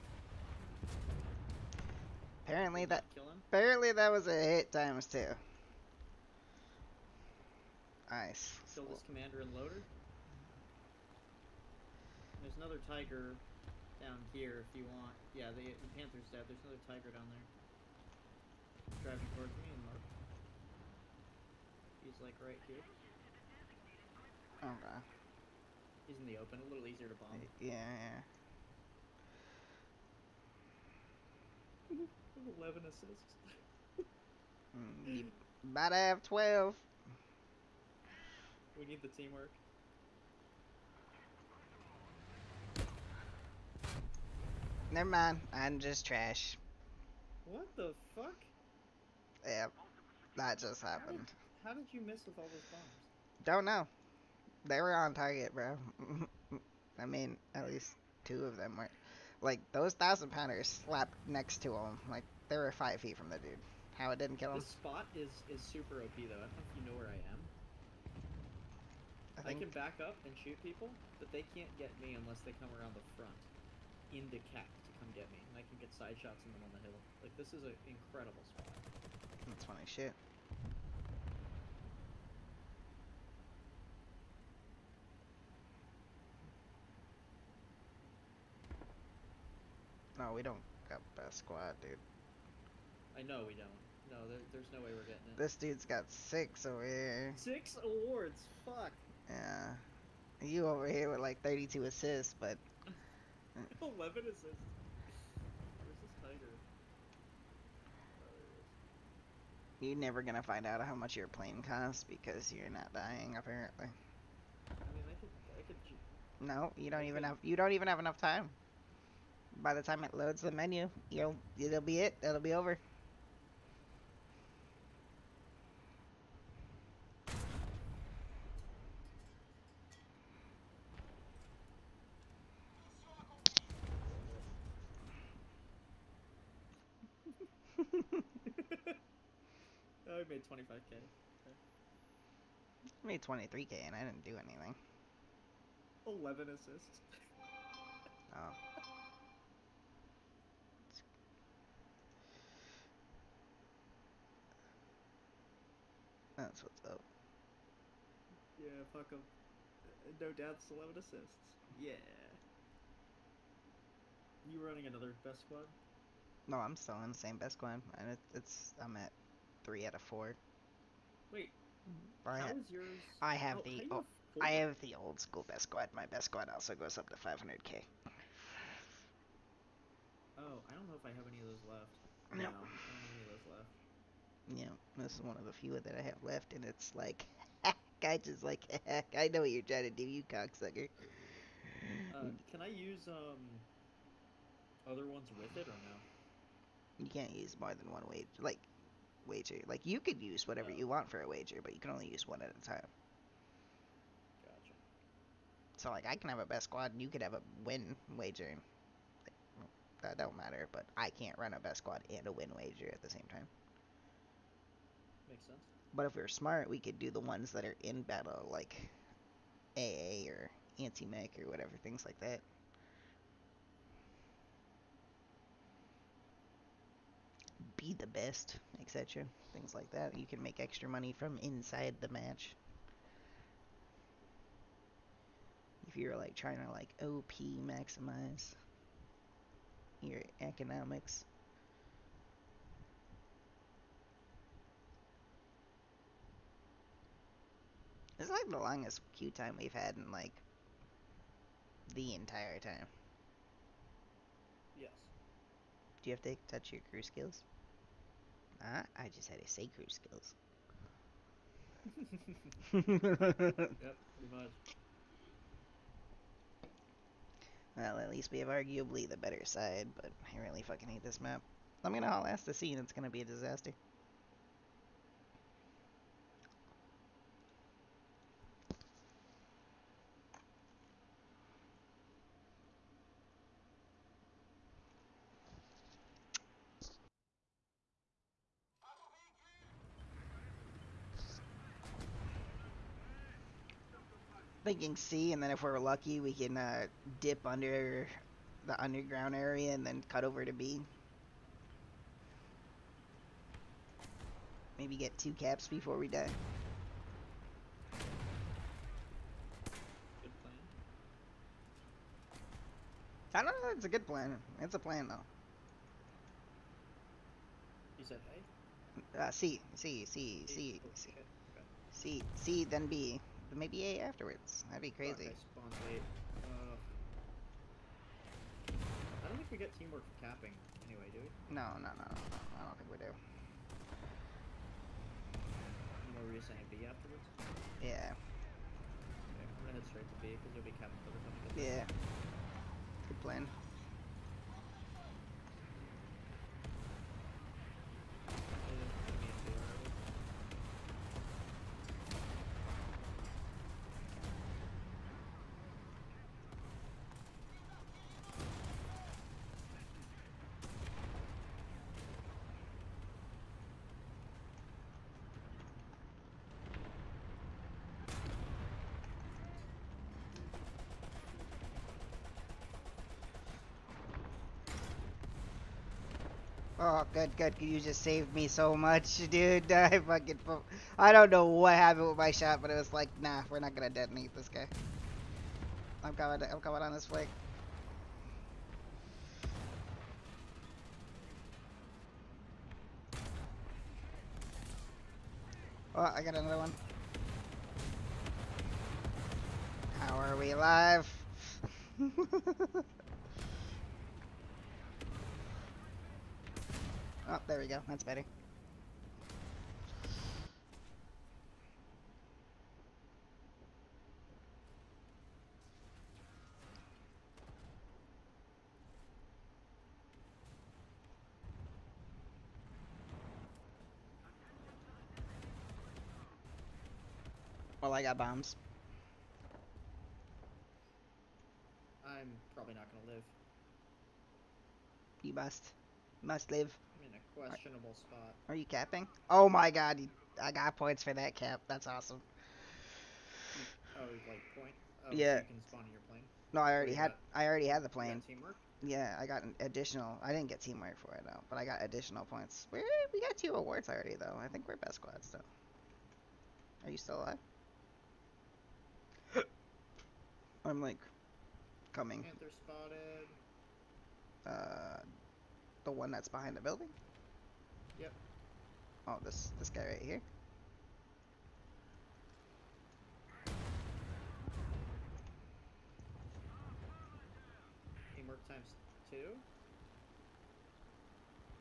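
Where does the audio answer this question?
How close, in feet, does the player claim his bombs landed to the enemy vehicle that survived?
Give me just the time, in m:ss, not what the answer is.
1:02.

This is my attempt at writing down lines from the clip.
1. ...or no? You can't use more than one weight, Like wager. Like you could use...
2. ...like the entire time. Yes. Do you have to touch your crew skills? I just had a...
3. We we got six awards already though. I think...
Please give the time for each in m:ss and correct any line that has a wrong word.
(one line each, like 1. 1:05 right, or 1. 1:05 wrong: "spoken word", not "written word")
1. 3:15 right
2. 4:10 right
3. 7:32 wrong: "two", not "six".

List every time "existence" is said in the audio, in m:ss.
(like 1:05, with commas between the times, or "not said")
not said.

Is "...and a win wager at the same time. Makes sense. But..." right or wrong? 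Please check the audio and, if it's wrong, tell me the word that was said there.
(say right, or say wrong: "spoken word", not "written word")
right.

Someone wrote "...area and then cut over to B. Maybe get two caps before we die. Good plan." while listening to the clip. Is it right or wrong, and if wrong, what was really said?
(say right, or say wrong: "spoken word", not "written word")
right.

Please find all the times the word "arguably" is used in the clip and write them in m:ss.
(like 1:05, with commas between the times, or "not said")
4:28.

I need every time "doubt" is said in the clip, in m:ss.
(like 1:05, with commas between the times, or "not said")
2:40.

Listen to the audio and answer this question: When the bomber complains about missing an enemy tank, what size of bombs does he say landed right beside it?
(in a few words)
thousand pounders.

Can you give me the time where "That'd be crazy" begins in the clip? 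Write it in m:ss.
5:24.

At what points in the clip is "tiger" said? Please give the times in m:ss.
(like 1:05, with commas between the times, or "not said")
0:12, 0:16.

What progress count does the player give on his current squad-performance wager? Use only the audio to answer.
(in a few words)
3 out of 4.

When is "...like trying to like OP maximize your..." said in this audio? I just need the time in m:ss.
3:56.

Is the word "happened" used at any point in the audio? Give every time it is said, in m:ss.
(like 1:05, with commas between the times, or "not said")
0:50, 6:21.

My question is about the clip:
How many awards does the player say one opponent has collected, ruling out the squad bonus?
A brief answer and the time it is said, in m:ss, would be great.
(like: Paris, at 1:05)
6, at 1:37.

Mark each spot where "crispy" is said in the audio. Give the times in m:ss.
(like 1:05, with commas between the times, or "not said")
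not said.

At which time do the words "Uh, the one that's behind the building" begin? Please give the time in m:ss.
7:44.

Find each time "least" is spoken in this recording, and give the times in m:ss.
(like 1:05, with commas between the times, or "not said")
0:57, 4:28.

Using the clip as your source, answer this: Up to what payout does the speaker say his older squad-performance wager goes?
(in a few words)
500k.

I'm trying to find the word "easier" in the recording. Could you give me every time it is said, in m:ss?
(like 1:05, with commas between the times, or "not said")
0:26.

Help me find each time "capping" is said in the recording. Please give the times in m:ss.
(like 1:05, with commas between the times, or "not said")
5:30, 5:40, 7:18.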